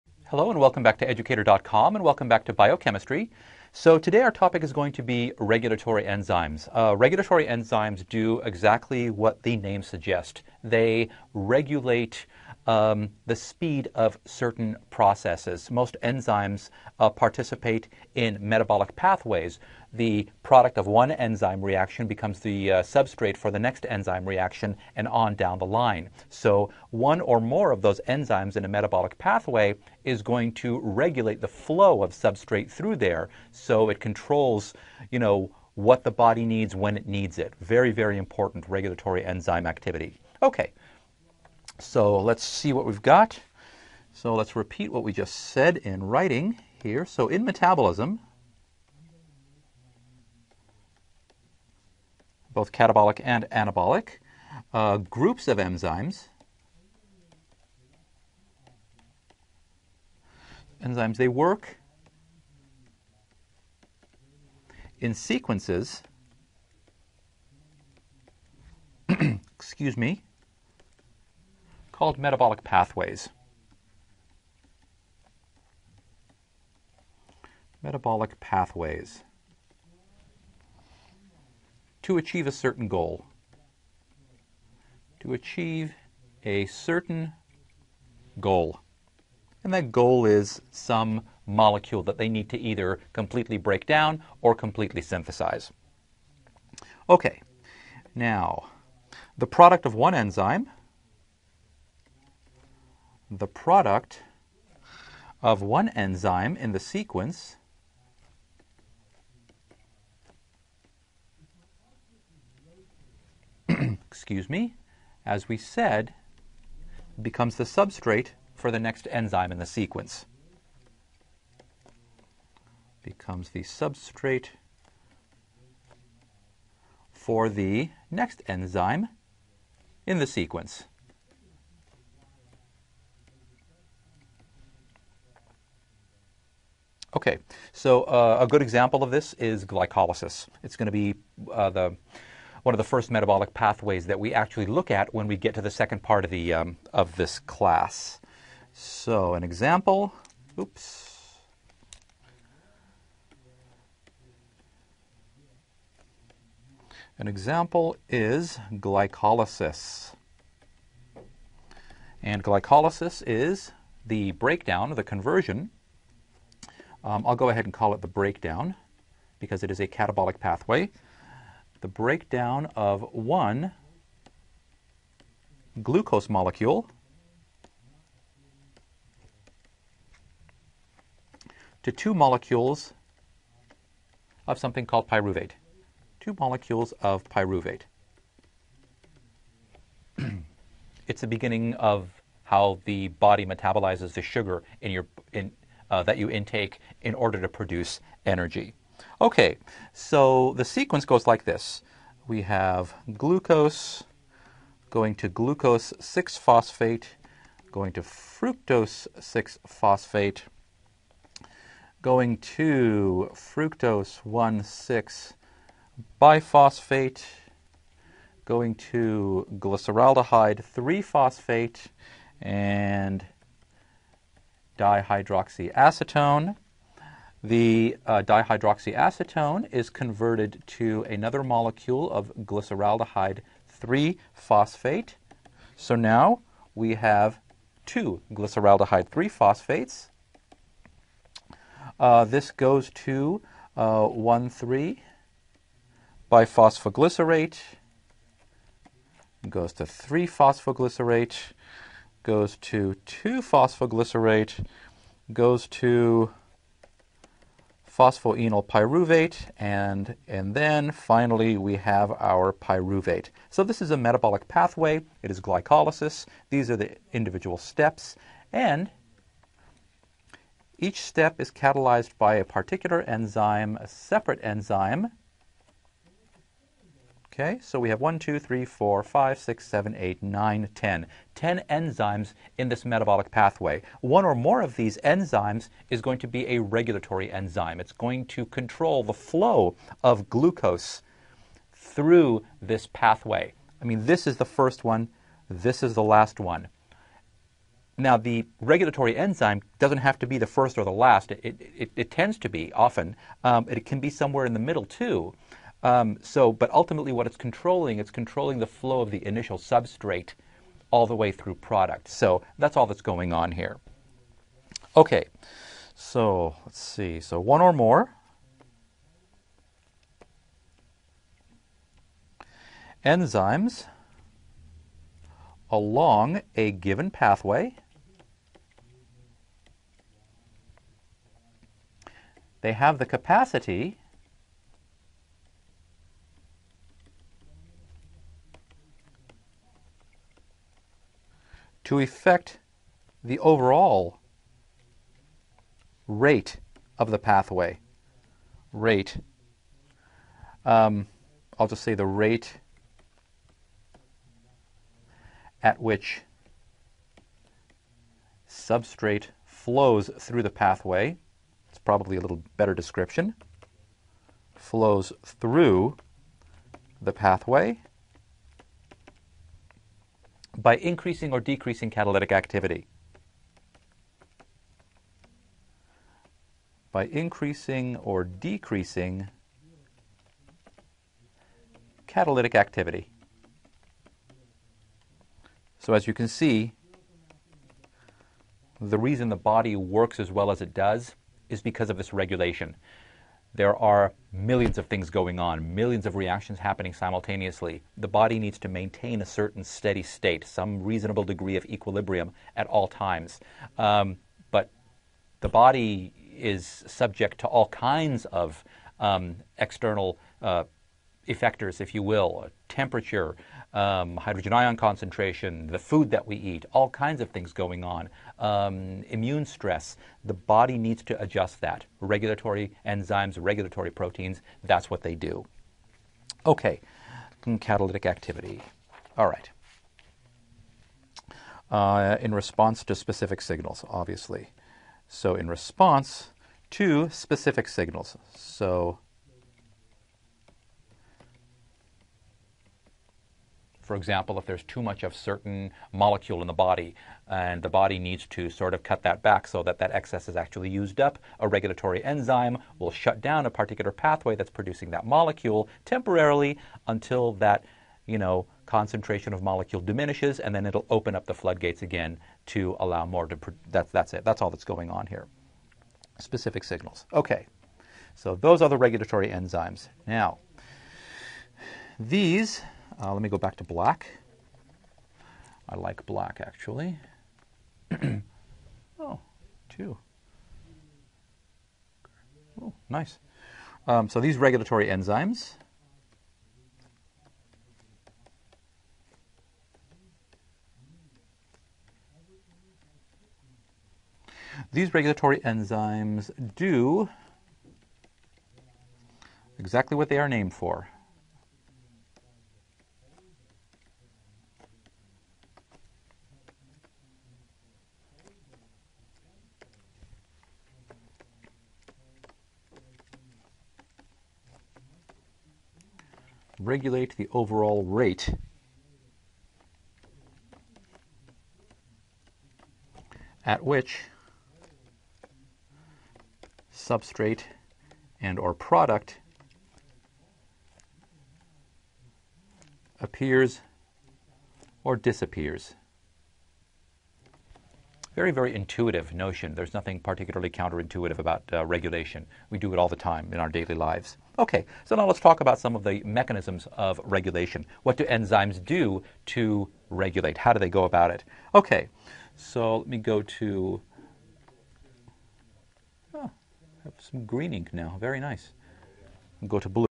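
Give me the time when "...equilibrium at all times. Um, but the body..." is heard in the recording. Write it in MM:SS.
06:41.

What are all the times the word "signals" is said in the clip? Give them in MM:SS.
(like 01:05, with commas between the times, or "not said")
07:13, 07:17, 07:46.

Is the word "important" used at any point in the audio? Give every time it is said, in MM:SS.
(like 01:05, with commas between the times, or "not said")
00:38.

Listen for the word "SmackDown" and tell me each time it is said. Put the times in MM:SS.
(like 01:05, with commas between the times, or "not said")
not said.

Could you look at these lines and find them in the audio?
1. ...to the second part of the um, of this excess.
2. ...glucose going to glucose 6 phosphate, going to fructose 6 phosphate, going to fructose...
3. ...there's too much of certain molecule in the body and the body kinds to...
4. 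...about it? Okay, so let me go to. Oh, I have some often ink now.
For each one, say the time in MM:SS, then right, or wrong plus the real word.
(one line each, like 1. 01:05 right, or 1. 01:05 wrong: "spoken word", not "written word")
1. 02:25 wrong: "class", not "excess"
2. 03:23 right
3. 07:24 wrong: "needs", not "kinds"
4. 09:10 wrong: "green", not "often".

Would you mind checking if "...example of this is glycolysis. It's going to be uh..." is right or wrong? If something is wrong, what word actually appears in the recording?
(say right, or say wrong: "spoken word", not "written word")
right.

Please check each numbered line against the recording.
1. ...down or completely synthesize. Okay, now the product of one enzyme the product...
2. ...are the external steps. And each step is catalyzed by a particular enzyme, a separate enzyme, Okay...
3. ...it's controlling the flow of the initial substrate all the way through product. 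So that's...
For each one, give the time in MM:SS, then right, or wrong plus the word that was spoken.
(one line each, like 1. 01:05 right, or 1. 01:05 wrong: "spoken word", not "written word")
1. 01:33 right
2. 04:26 wrong: "individual", not "external"
3. 05:07 right.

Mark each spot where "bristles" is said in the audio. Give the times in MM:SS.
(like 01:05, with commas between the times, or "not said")
not said.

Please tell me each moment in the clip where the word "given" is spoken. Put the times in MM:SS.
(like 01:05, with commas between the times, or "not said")
05:26.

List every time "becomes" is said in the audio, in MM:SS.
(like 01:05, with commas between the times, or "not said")
00:22, 01:57, 02:03.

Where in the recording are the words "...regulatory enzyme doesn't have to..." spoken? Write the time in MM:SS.
04:58.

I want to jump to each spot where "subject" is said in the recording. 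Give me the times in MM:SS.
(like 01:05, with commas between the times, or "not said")
06:46.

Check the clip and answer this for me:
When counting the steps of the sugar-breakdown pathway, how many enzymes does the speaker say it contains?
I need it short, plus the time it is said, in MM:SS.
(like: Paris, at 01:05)
10, at 04:41.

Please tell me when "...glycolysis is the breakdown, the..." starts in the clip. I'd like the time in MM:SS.
02:42.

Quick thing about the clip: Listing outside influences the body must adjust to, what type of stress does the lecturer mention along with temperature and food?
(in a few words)
Immune stress.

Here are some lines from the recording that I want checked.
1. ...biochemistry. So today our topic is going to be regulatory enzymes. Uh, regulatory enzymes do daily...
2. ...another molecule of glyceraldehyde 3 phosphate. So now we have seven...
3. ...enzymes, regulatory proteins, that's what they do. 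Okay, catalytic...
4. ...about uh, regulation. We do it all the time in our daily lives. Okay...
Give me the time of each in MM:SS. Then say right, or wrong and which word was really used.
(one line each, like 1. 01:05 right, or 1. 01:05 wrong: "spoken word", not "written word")
1. 00:02 wrong: "exactly", not "daily"
2. 03:51 wrong: "two", not "seven"
3. 07:02 right
4. 09:01 right.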